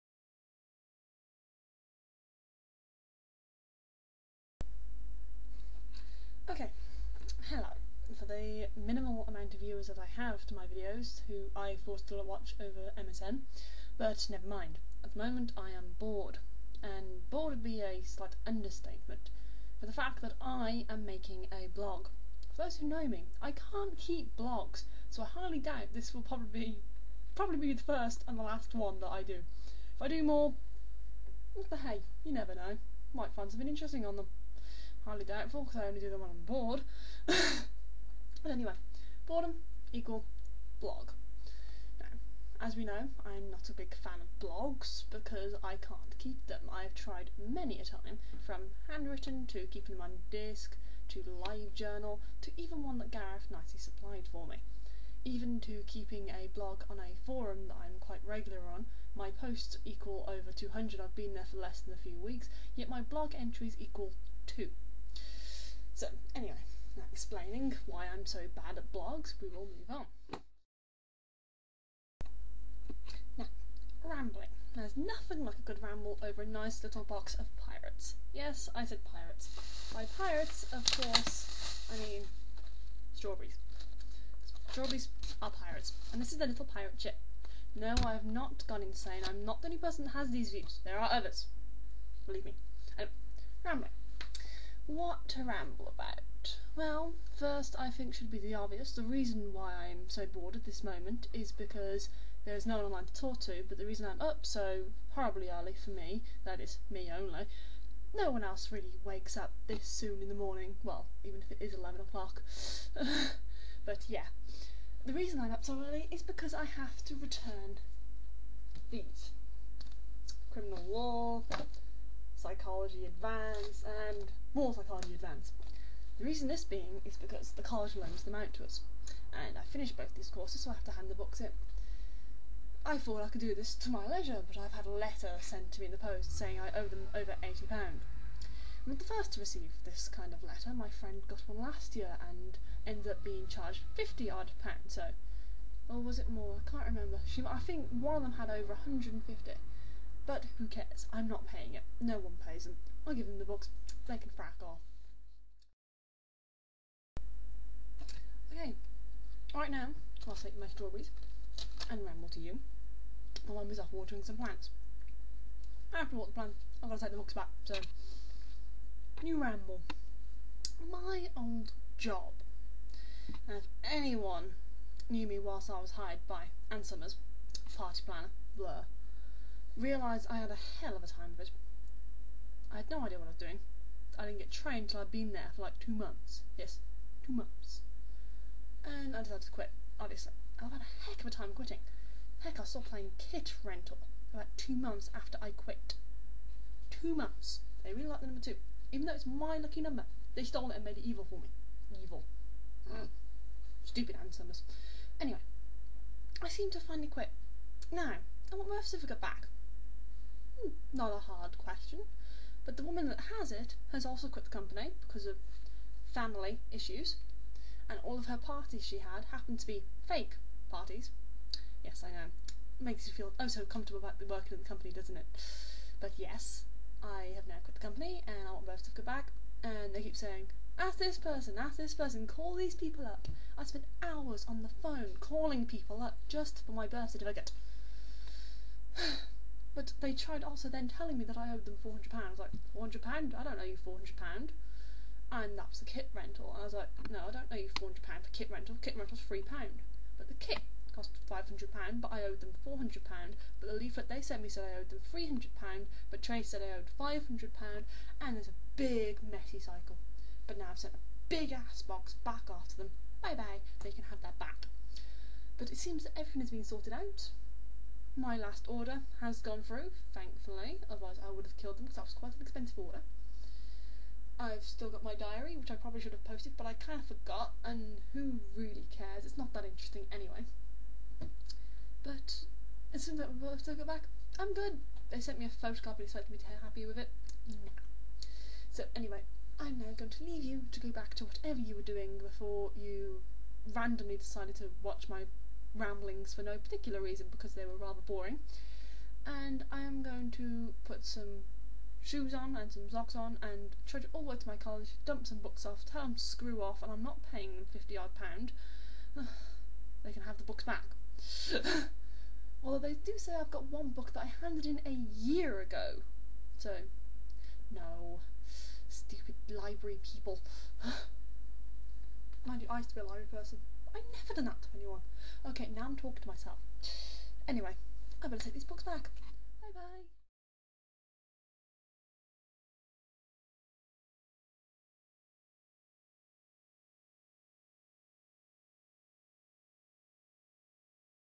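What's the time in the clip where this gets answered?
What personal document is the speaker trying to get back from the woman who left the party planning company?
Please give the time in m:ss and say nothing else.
3:56.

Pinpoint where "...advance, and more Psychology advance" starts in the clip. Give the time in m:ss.
2:03.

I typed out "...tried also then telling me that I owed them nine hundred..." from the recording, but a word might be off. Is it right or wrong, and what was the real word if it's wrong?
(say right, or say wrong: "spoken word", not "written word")
wrong: "four", not "nine".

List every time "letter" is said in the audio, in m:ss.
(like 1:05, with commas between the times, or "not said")
2:14, 2:20.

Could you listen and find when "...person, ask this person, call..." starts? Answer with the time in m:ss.
3:51.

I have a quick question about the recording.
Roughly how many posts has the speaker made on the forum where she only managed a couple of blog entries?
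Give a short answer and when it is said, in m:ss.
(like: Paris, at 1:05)
Over 200, at 1:00.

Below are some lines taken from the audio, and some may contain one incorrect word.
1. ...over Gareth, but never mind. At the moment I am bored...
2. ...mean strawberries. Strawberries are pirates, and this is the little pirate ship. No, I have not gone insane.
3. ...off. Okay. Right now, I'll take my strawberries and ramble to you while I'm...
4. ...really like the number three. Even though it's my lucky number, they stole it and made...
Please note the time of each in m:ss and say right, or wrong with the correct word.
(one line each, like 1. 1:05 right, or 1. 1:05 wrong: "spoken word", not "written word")
1. 0:12 wrong: "MSN", not "Gareth"
2. 1:21 right
3. 2:34 right
4. 3:17 wrong: "two", not "three".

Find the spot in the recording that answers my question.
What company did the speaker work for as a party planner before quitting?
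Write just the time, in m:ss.
2:56.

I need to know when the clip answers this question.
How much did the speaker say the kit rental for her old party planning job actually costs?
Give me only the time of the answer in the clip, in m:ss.
4:09.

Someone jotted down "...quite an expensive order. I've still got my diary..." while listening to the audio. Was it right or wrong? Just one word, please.
right.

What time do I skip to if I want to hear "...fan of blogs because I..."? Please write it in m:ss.
0:43.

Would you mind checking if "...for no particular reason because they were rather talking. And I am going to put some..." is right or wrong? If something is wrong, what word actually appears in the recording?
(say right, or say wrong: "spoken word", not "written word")
wrong: "boring", not "talking".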